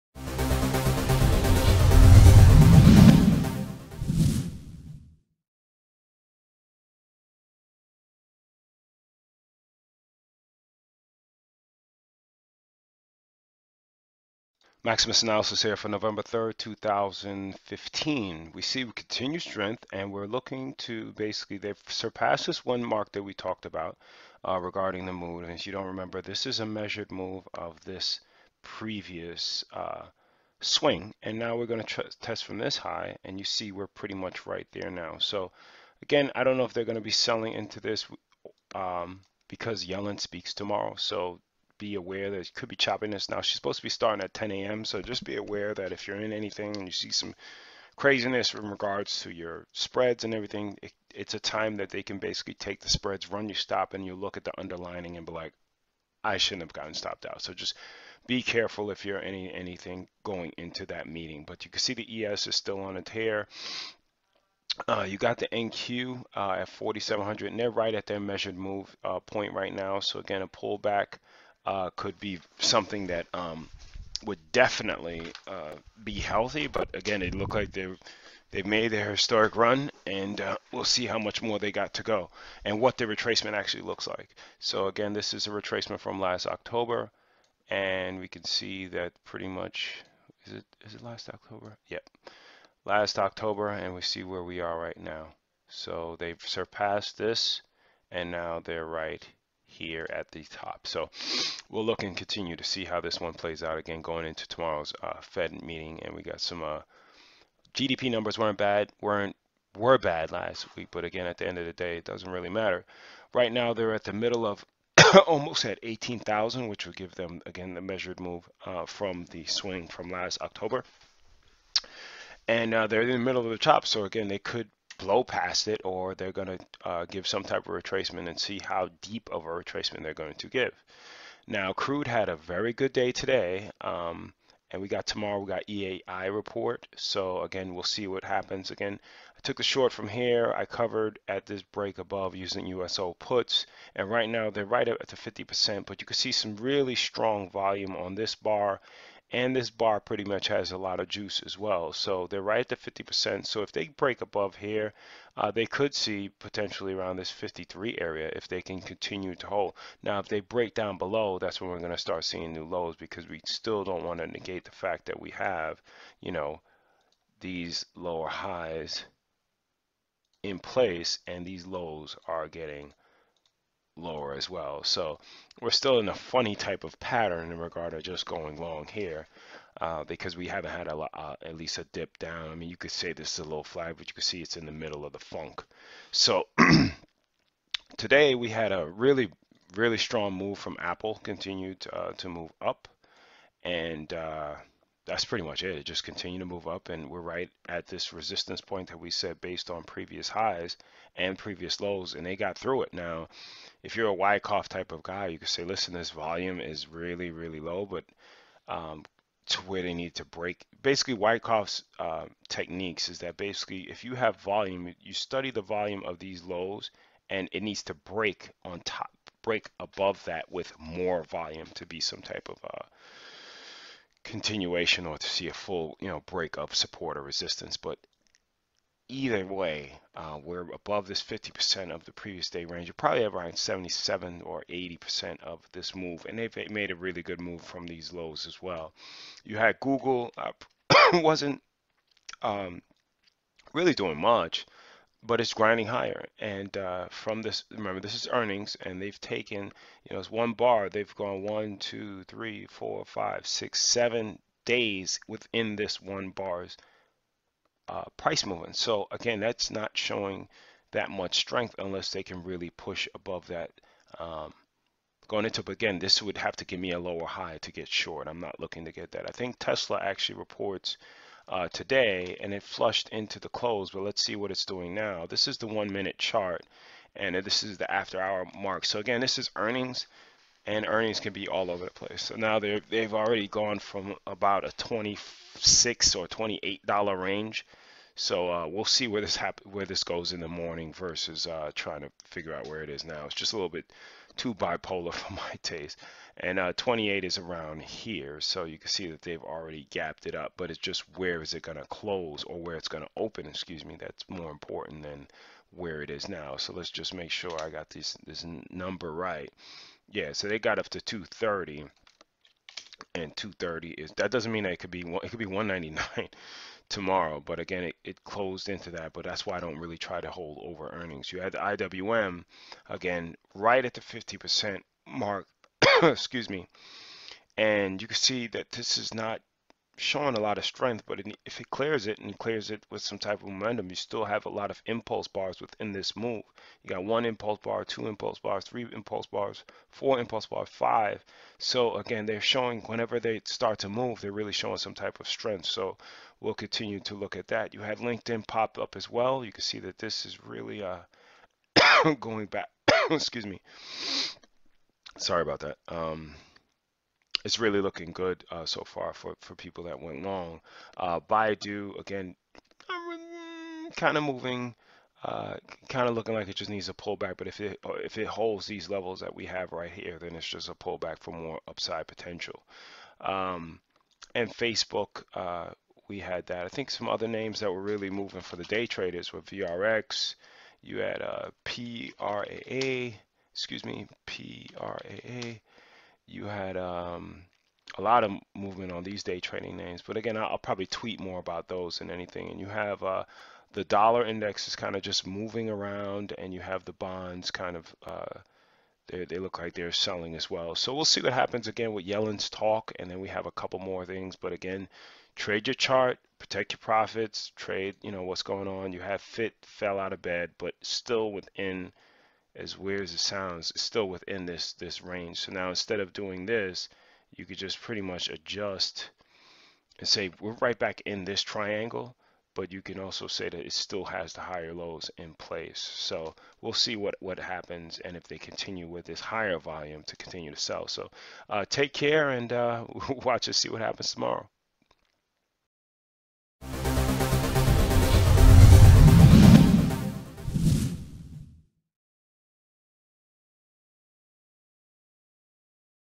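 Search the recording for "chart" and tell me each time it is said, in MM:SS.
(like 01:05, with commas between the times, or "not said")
04:36, 06:45.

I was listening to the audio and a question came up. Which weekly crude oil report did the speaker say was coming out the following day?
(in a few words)
EAI report.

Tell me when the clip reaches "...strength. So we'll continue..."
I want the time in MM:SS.
05:45.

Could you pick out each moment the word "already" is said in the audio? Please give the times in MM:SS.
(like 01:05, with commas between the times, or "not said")
04:43, 04:59.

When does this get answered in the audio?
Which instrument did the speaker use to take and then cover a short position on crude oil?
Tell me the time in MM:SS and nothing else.
02:22.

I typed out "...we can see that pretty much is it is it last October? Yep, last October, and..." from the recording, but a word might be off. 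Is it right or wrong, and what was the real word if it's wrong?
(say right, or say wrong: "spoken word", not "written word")
right.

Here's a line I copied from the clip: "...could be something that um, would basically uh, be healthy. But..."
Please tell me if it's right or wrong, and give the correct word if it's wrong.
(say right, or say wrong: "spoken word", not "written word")
wrong: "definitely", not "basically".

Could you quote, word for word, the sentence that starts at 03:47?
But either way, uh, we're above this 50% of the previous day range.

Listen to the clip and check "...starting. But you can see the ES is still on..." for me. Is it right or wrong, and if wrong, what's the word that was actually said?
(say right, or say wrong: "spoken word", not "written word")
wrong: "meeting", not "starting".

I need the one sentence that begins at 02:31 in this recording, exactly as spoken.
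So they're right at the 50%.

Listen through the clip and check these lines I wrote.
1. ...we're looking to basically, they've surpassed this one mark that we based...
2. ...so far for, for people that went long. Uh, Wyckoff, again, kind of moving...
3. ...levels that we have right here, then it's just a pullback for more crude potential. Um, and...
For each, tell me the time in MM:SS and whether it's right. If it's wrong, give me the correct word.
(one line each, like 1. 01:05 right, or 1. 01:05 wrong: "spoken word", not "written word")
1. 00:20 wrong: "talked", not "based"
2. 05:58 wrong: "Baidu", not "Wyckoff"
3. 06:08 wrong: "upside", not "crude".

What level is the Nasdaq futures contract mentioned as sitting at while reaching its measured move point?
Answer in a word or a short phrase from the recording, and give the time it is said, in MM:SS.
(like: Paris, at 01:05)
4,700, at 01:06.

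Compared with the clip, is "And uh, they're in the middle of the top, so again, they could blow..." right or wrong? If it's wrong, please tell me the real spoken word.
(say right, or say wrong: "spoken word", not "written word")
right.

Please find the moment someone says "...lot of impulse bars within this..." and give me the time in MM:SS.
05:34.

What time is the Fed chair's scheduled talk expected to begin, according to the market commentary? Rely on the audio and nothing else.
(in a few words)
10 a.m.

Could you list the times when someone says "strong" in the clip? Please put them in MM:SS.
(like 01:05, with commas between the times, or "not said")
02:26, 03:09.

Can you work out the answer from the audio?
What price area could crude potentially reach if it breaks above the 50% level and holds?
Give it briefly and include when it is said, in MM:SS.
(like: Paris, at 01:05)
53, at 02:37.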